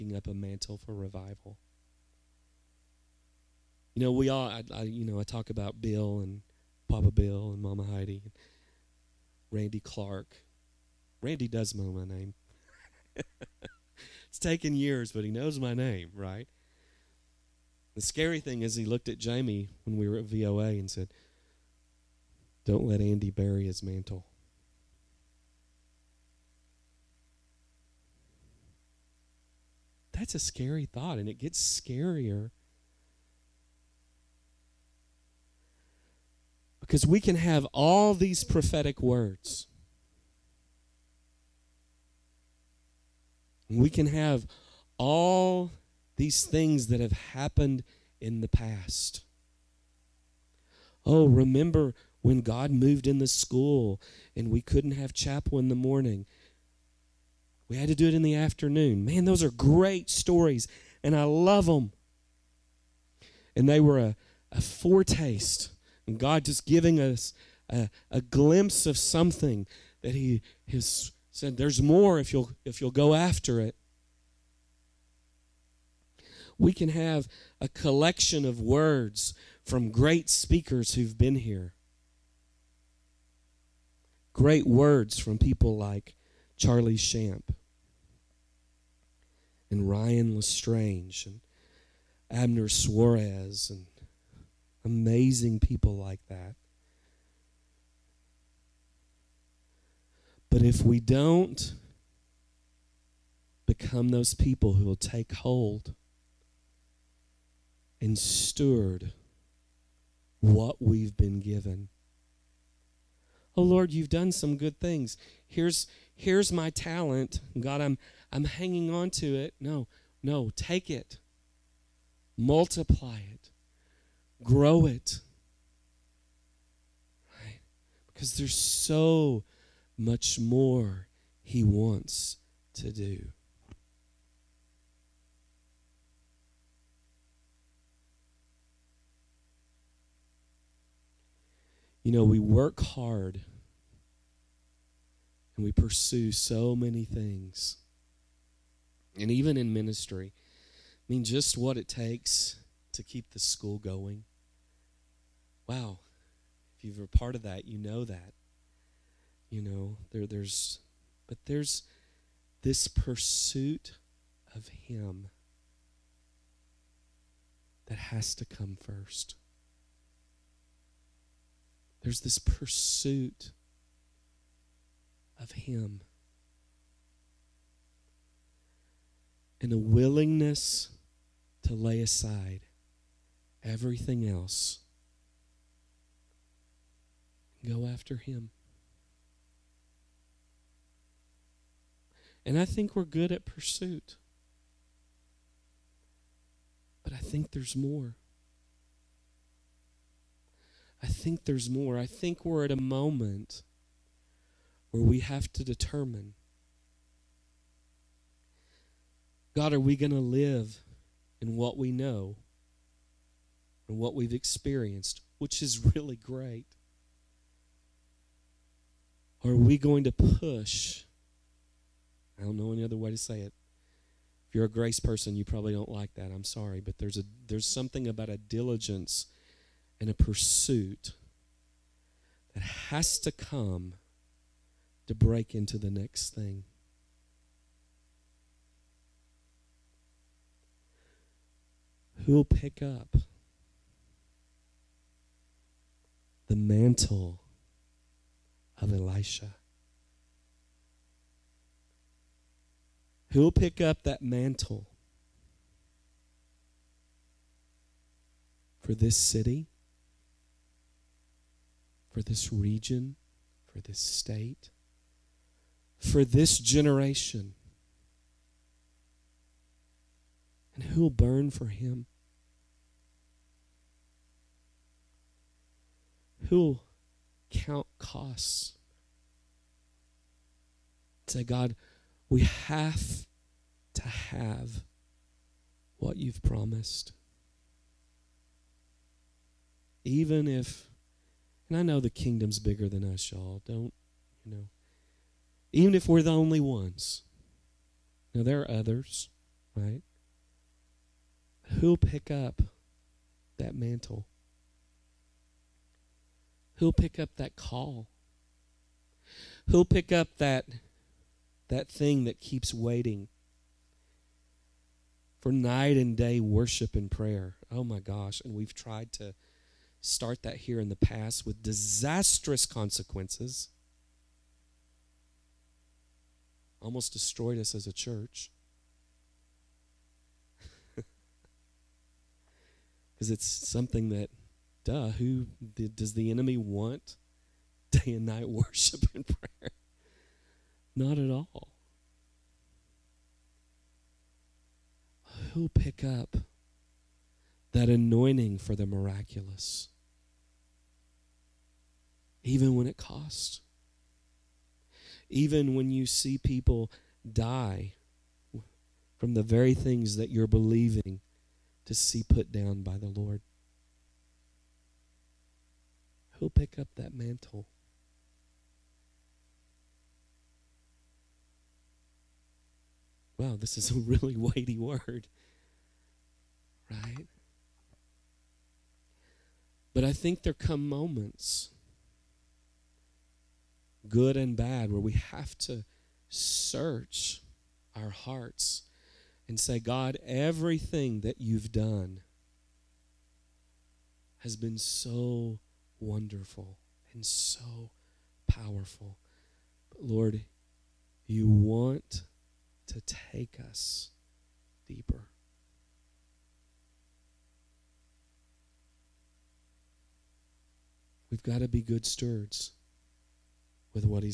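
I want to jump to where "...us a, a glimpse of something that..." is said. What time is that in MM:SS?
01:07.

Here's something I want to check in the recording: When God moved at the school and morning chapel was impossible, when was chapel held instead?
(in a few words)
In the afternoon.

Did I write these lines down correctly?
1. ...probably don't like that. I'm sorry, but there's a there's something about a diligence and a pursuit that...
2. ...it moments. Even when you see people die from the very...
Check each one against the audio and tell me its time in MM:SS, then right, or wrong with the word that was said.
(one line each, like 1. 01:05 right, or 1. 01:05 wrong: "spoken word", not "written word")
1. 03:45 right
2. 05:52 wrong: "costs", not "moments".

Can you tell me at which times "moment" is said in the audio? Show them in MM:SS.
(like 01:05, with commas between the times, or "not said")
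03:22, 06:20.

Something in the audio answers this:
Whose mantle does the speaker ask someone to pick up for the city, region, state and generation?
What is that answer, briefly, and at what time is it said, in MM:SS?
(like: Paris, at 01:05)
Elisha, at 04:08.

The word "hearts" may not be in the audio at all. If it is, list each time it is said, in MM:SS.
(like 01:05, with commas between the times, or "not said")
06:28.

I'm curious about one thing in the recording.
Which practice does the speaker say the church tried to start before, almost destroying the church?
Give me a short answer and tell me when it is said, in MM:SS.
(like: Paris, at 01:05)
Night and day worship and prayer, at 05:15.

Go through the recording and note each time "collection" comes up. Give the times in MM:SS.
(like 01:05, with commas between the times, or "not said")
01:17.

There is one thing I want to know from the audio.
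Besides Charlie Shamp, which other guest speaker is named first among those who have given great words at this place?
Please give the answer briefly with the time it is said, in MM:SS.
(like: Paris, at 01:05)
Ryan Lestrange, at 01:29.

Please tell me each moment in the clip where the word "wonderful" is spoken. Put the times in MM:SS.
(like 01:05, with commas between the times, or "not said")
06:36.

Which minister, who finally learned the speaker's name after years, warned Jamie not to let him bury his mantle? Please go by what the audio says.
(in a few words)
Randy Clark.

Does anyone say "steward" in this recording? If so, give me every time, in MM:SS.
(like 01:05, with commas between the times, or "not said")
01:48, 06:52.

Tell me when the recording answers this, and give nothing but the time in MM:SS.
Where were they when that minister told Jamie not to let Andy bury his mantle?
00:20.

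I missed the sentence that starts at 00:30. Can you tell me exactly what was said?
That's a scary thought, and it gets scarier Because we can have all these prophetic words.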